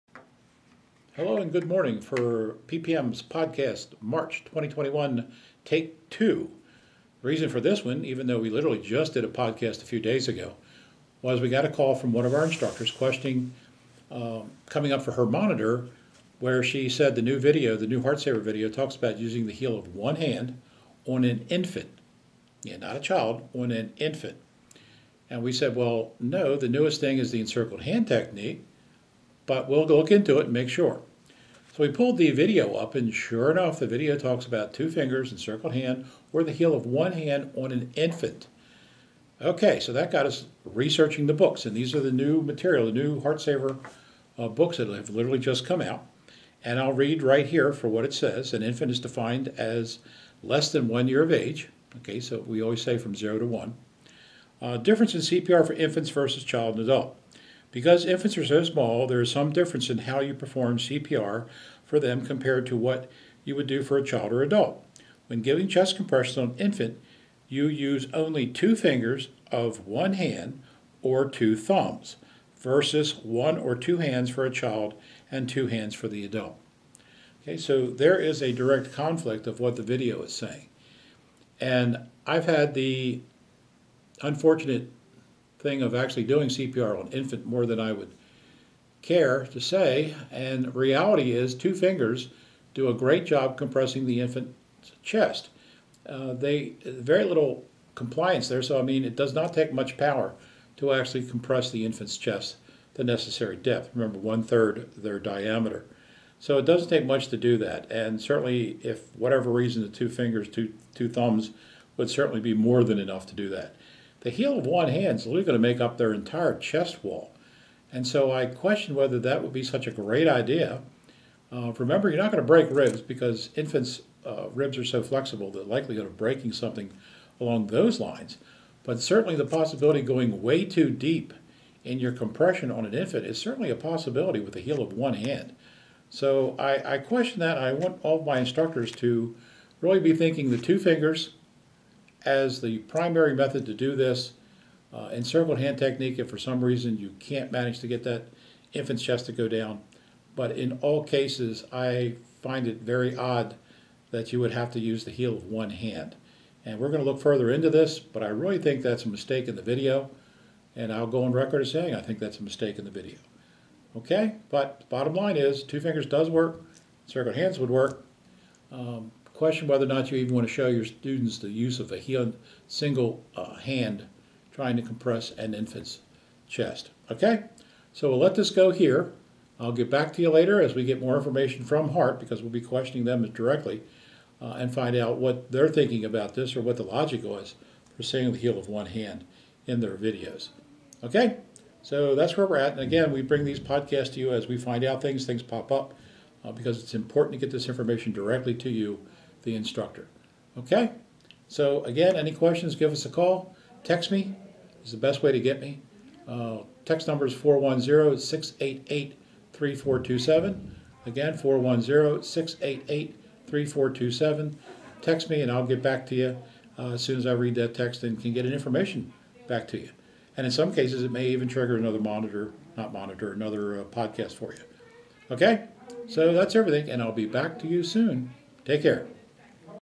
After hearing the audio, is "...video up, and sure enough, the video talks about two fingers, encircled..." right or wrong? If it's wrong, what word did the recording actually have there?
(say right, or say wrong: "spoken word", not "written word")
right.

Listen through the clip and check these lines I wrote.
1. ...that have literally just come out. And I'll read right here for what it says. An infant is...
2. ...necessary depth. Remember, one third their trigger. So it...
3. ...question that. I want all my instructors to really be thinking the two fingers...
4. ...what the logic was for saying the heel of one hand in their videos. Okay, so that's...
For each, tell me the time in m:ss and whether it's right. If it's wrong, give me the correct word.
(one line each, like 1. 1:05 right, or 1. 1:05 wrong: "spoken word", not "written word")
1. 0:44 right
2. 1:43 wrong: "diameter", not "trigger"
3. 2:16 right
4. 3:06 right.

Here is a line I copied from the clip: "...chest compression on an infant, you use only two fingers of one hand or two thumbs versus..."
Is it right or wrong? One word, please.
right.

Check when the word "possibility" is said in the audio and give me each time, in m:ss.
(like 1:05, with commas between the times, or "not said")
2:09, 2:13.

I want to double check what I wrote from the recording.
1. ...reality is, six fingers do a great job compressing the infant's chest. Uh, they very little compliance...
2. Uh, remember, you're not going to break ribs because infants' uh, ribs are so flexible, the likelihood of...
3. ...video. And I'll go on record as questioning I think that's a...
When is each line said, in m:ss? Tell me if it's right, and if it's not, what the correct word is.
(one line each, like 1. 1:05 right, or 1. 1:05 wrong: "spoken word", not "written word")
1. 1:30 wrong: "two", not "six"
2. 2:01 right
3. 2:39 wrong: "saying", not "questioning".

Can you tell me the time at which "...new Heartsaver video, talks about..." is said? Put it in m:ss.
0:17.